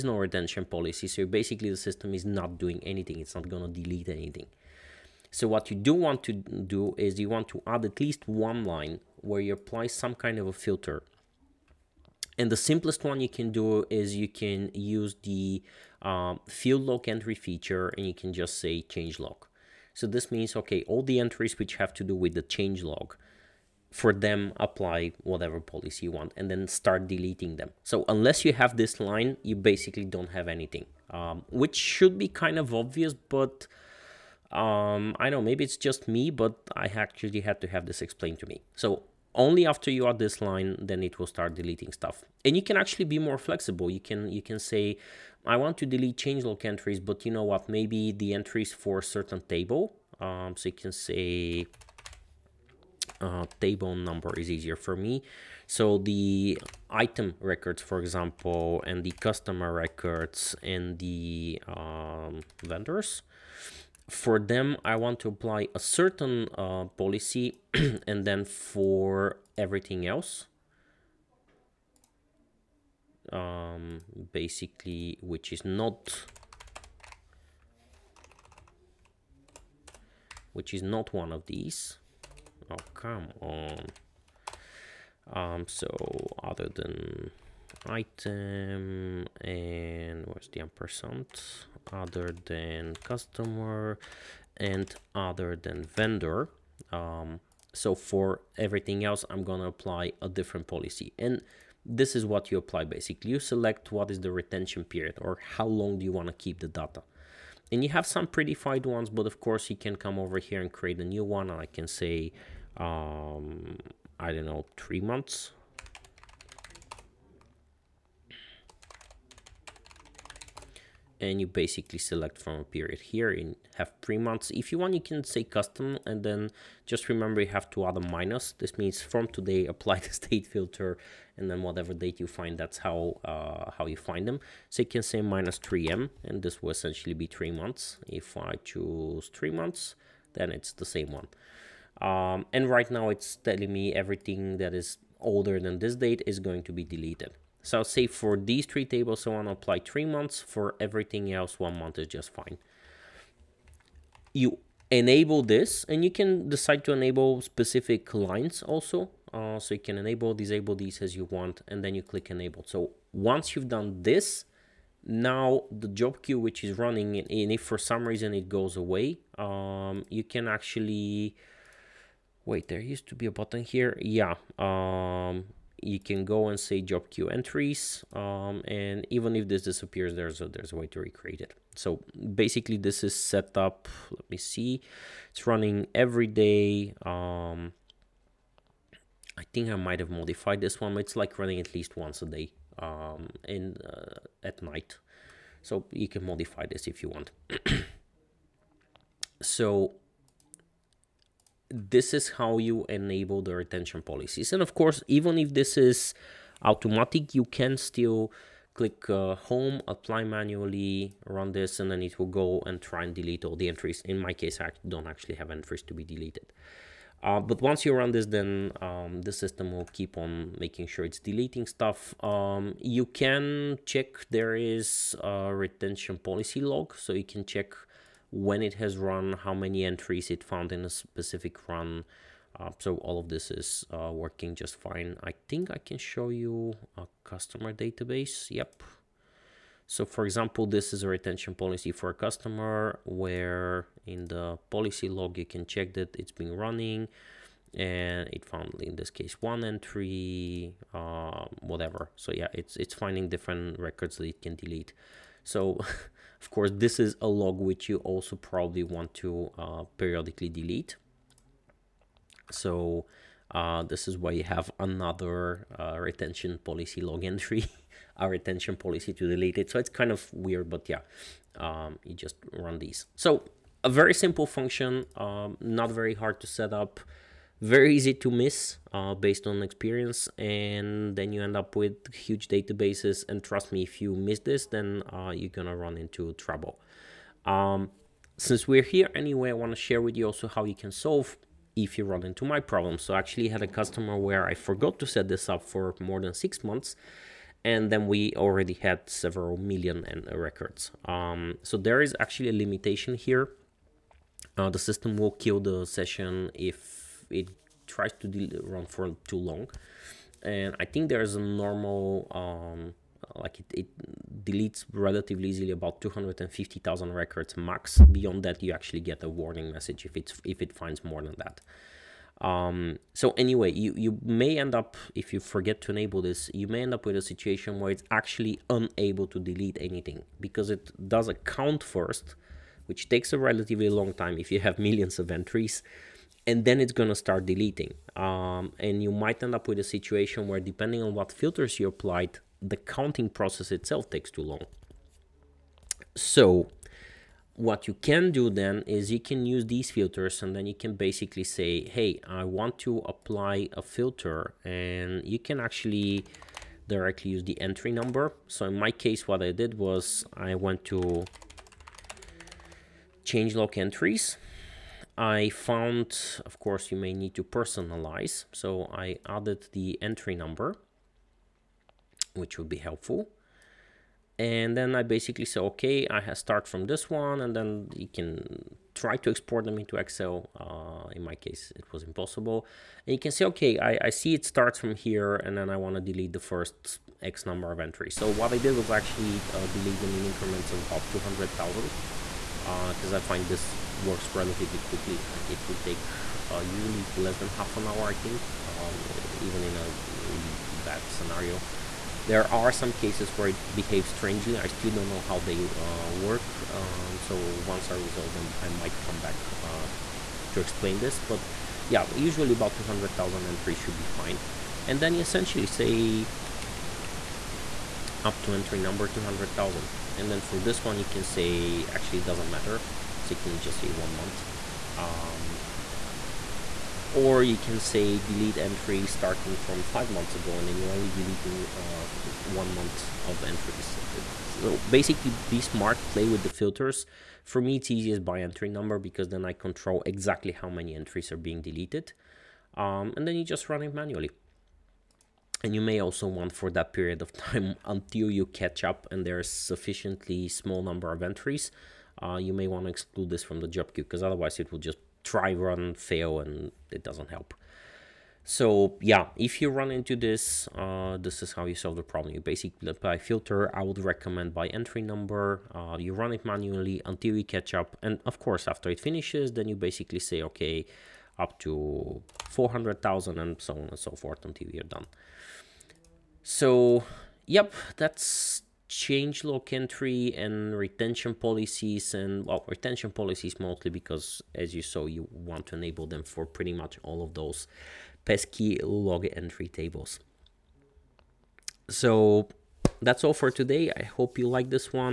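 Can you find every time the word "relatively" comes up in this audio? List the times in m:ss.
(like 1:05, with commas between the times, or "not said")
5:14, 5:33, 6:34.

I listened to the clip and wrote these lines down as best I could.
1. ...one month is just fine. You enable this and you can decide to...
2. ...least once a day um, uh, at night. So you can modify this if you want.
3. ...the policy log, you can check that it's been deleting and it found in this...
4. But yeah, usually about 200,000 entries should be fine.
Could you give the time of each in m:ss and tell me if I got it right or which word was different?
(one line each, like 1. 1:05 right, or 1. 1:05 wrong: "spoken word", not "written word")
1. 2:31 right
2. 3:11 right
3. 4:04 wrong: "running", not "deleting"
4. 6:51 right.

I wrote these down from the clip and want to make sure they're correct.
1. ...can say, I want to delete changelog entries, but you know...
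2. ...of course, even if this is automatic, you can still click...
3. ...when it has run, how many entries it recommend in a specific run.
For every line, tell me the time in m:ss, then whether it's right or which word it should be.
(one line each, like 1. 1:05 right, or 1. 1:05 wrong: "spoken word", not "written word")
1. 0:44 right
2. 3:24 right
3. 3:48 wrong: "found", not "recommend".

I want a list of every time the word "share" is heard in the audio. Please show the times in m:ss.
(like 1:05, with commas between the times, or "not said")
4:49.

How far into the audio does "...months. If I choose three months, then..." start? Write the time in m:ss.
2:17.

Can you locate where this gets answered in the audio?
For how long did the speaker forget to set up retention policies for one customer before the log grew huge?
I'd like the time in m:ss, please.
4:56.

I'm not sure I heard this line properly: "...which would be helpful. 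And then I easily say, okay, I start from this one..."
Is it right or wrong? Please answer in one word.
wrong.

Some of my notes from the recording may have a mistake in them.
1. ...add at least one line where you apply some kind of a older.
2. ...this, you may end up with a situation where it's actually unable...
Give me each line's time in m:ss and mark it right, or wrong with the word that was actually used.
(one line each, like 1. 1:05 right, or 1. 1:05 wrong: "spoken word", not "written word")
1. 0:07 wrong: "filter", not "older"
2. 5:26 right.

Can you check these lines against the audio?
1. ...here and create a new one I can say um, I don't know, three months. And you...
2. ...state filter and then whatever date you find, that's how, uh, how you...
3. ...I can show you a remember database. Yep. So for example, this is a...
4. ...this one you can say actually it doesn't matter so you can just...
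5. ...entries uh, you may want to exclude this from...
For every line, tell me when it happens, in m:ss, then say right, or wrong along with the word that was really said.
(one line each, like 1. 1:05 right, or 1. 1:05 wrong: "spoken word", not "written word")
1. 1:50 right
2. 2:10 right
3. 3:55 wrong: "customer", not "remember"
4. 7:00 right
5. 7:31 right.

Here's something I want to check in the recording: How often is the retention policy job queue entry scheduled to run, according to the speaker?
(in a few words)
Every day.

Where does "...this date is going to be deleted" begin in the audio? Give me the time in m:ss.
2:25.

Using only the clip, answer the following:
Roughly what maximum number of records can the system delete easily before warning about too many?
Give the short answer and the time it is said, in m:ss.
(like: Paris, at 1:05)
250,000, at 5:16.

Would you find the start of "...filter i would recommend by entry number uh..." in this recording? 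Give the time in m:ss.
7:43.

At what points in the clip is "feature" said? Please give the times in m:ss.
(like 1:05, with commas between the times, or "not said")
0:17.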